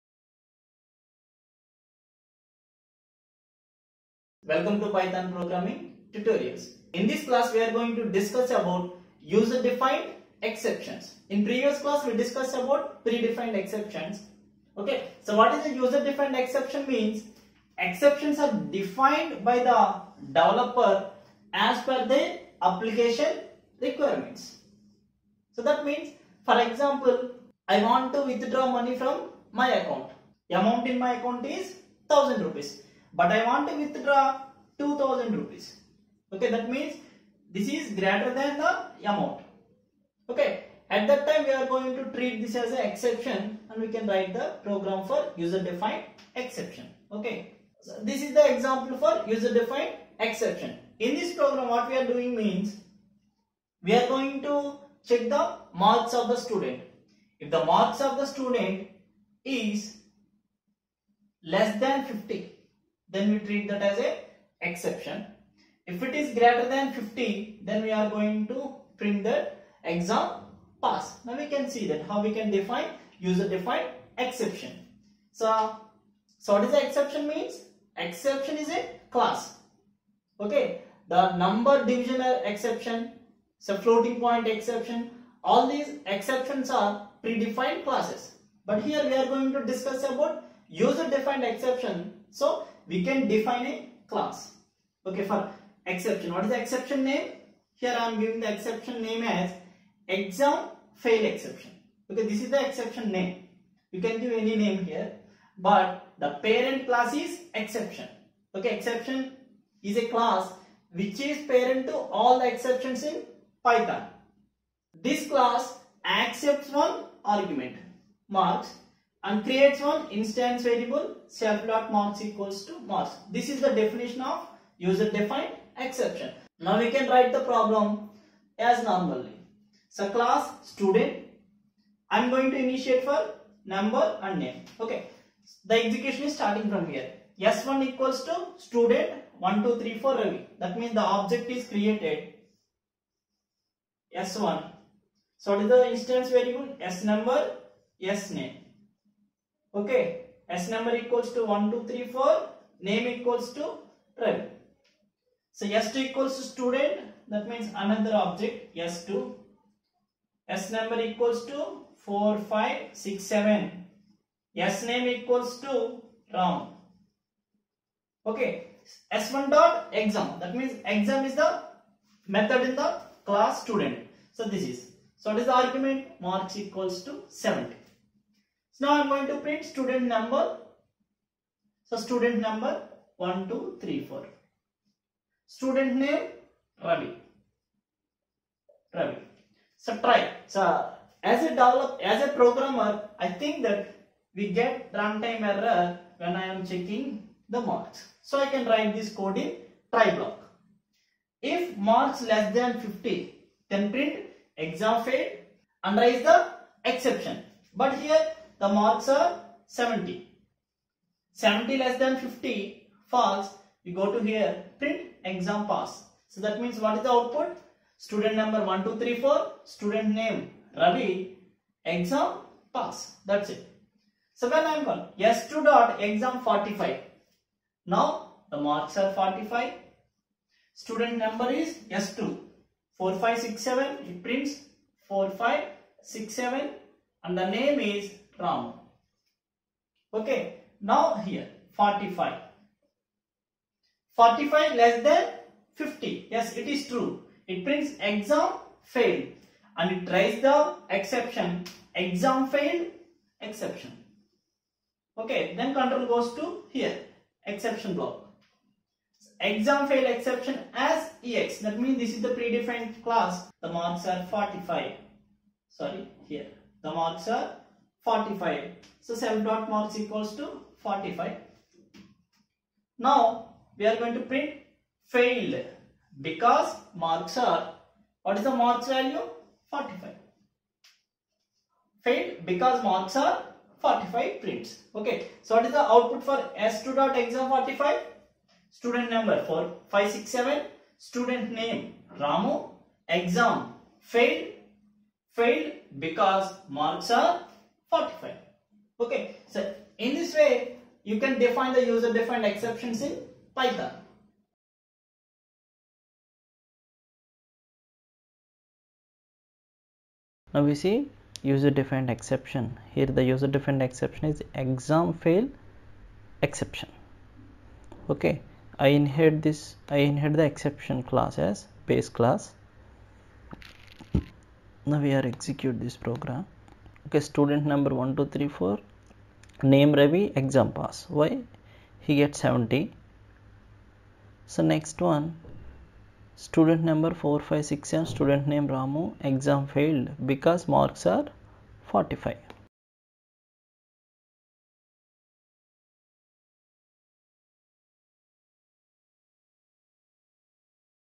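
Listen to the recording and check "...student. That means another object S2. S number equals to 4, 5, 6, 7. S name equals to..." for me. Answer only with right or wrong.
right.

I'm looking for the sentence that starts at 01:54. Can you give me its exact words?
This class accepts one argument, marks, and creates one instance variable self.marks equals to marks.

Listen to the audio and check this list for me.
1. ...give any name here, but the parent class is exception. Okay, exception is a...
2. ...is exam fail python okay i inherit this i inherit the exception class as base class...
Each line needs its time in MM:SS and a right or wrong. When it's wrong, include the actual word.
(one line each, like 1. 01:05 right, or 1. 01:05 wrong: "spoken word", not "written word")
1. 01:44 right
2. 05:14 wrong: "exception", not "python".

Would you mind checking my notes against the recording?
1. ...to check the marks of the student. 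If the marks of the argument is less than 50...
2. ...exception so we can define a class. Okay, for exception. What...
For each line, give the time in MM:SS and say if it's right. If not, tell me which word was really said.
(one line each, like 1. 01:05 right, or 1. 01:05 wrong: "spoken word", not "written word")
1. 00:54 wrong: "student", not "argument"
2. 01:31 right.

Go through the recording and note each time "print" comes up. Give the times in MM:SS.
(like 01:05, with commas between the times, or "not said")
01:08, 02:59, 03:23, 03:34, 03:54, 04:34, 04:44.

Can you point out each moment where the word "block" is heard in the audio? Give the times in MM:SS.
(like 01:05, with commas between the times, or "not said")
03:20, 04:17.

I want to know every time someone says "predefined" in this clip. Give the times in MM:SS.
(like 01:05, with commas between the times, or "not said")
00:13, 01:27, 04:22.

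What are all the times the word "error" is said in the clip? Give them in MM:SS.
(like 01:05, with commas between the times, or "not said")
03:15.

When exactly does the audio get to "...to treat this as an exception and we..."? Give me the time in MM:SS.
00:41.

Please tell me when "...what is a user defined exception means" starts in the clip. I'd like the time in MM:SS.
00:15.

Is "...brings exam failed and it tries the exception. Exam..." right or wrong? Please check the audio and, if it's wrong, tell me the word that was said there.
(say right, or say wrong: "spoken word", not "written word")
right.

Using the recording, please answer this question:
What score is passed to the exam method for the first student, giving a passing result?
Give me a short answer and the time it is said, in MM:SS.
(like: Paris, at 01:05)
70, at 02:56.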